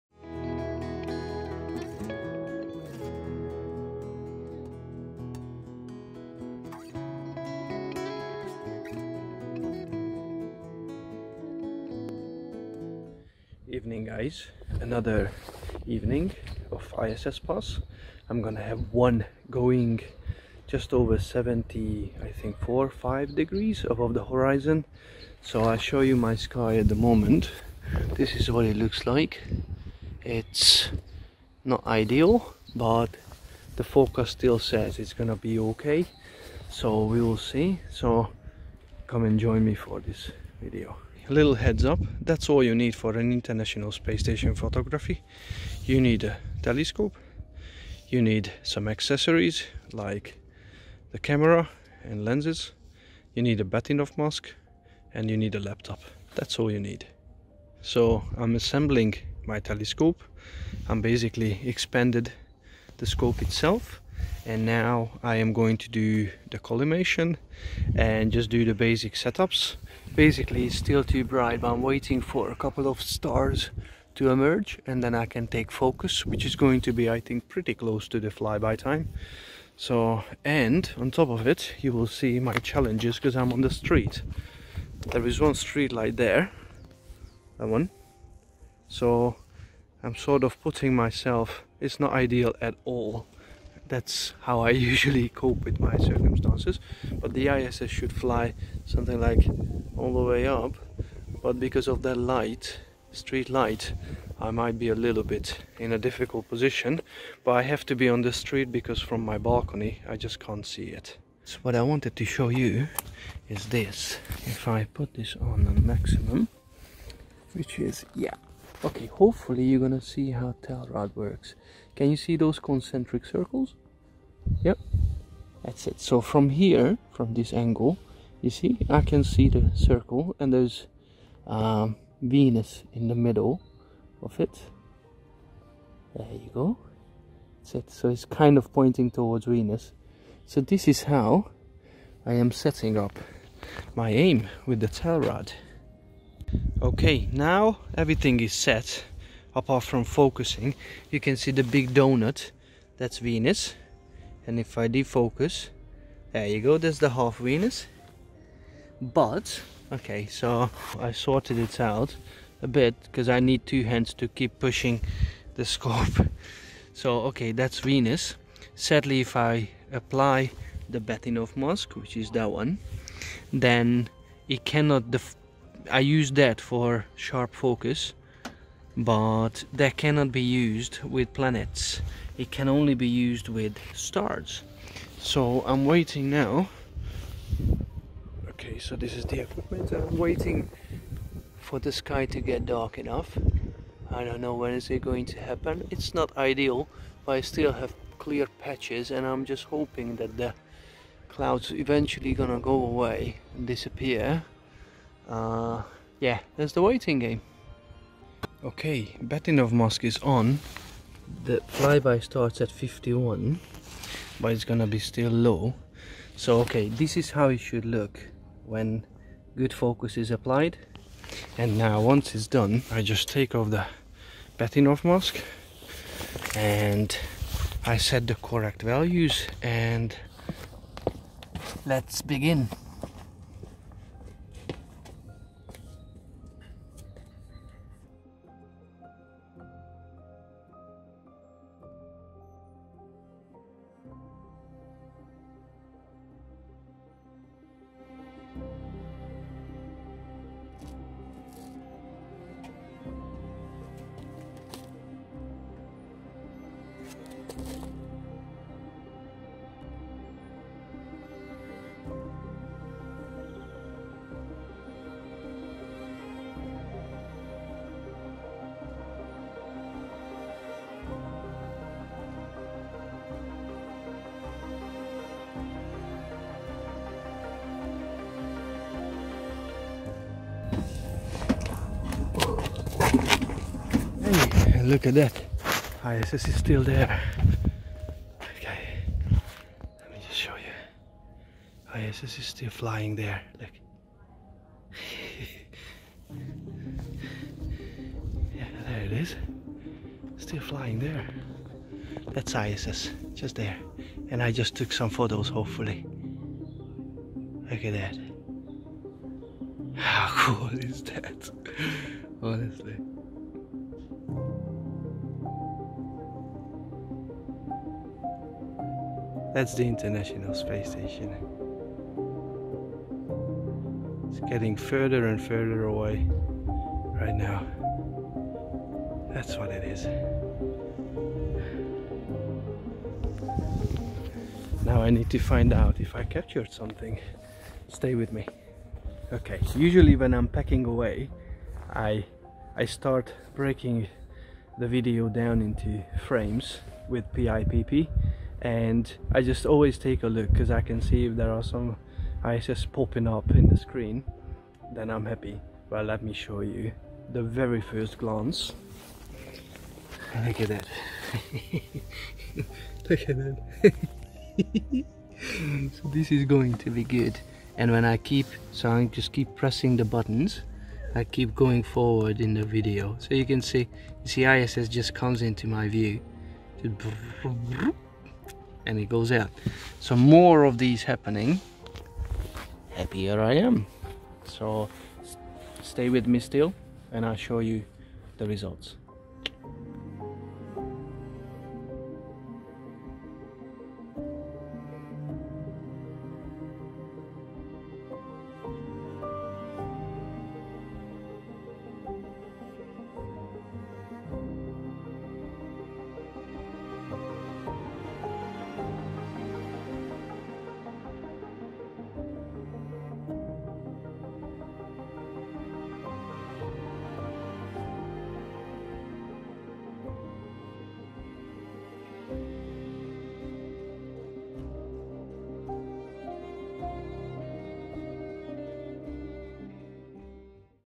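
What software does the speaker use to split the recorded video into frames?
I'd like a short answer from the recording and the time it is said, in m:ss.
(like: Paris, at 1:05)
PIPP, at 5:47.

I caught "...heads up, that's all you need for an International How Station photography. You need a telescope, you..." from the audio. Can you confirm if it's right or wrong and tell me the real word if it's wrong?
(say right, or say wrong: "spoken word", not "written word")
wrong: "Space", not "How".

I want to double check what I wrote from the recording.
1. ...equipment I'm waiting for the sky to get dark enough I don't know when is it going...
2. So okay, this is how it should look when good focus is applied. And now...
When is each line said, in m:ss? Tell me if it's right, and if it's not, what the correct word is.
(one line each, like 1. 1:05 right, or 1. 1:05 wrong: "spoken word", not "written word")
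1. 3:09 right
2. 3:36 right.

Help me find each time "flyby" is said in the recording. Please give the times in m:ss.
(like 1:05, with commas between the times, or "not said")
1:18, 3:31.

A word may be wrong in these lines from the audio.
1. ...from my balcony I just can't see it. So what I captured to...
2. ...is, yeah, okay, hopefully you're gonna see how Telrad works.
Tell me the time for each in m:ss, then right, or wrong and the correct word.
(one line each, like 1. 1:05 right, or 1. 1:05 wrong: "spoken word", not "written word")
1. 1:49 wrong: "wanted", not "captured"
2. 1:57 right.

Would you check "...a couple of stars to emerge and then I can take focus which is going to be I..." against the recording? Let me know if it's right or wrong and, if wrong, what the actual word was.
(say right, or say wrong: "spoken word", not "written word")
right.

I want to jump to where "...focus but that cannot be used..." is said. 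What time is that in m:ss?
2:57.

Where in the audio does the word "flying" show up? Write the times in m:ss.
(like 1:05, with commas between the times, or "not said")
4:52, 5:00.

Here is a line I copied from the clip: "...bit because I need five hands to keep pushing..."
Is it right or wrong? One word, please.
wrong.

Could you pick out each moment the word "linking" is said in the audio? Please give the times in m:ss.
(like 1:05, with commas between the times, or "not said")
not said.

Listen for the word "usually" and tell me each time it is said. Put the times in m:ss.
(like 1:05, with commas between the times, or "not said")
1:34, 5:39.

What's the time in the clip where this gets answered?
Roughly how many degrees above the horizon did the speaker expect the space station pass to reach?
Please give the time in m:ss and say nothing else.
0:21.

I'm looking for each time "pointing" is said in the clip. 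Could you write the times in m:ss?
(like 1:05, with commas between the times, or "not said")
2:18.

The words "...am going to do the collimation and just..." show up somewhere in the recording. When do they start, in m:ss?
1:05.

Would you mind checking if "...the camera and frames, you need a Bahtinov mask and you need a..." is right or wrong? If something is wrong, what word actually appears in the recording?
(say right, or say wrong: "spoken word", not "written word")
wrong: "lenses", not "frames".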